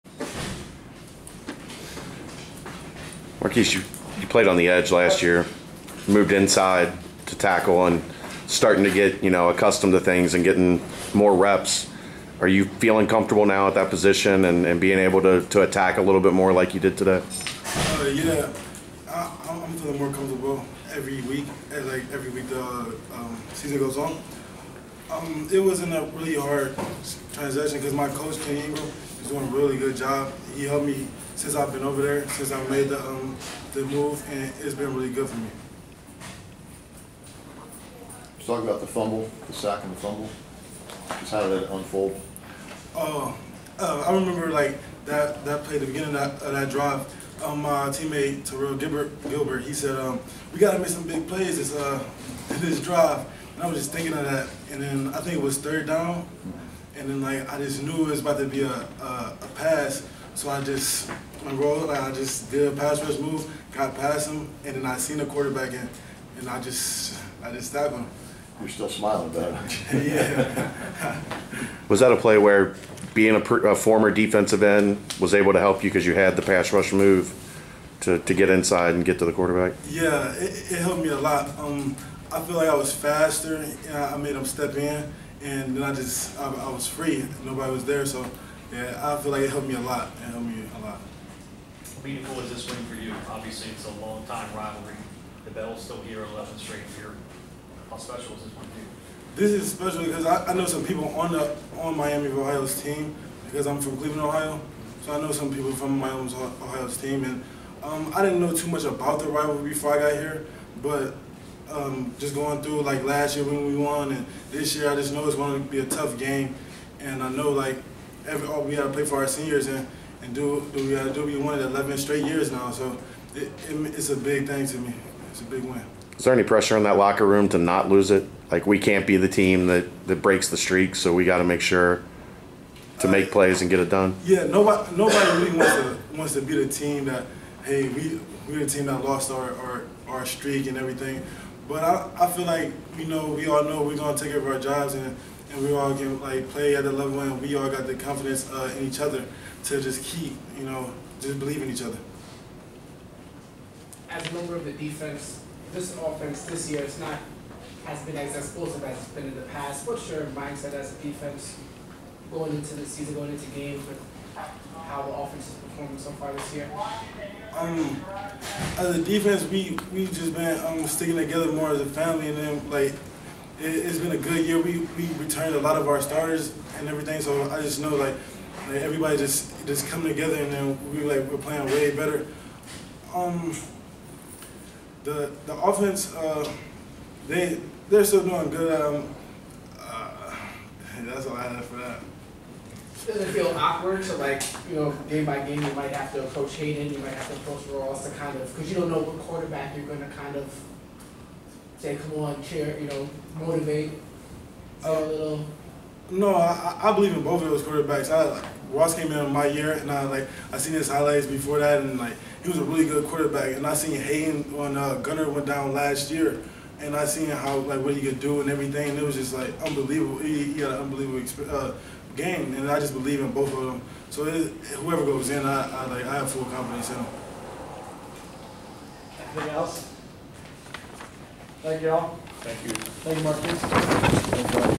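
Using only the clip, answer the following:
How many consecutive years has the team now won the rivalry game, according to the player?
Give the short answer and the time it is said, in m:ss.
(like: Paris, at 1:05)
11, at 2:01.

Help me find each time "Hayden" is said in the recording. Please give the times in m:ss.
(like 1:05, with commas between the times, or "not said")
3:16, 3:33.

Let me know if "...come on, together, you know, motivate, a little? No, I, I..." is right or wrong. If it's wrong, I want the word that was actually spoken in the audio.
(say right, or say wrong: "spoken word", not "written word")
wrong: "cheer", not "together".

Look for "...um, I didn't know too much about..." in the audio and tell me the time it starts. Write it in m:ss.
1:47.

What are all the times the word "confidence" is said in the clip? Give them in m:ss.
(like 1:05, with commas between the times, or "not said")
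2:27, 3:46.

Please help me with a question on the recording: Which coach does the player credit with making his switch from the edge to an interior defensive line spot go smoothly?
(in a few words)
Ken Ingram.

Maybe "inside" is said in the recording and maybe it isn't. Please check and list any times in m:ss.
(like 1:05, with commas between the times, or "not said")
0:06, 1:18.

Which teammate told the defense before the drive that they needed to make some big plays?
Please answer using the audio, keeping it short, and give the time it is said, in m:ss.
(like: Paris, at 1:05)
Terrell Gilbert, at 0:48.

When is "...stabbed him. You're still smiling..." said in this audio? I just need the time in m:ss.
1:07.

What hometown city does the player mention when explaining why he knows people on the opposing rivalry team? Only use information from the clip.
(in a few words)
Cleveland, Ohio.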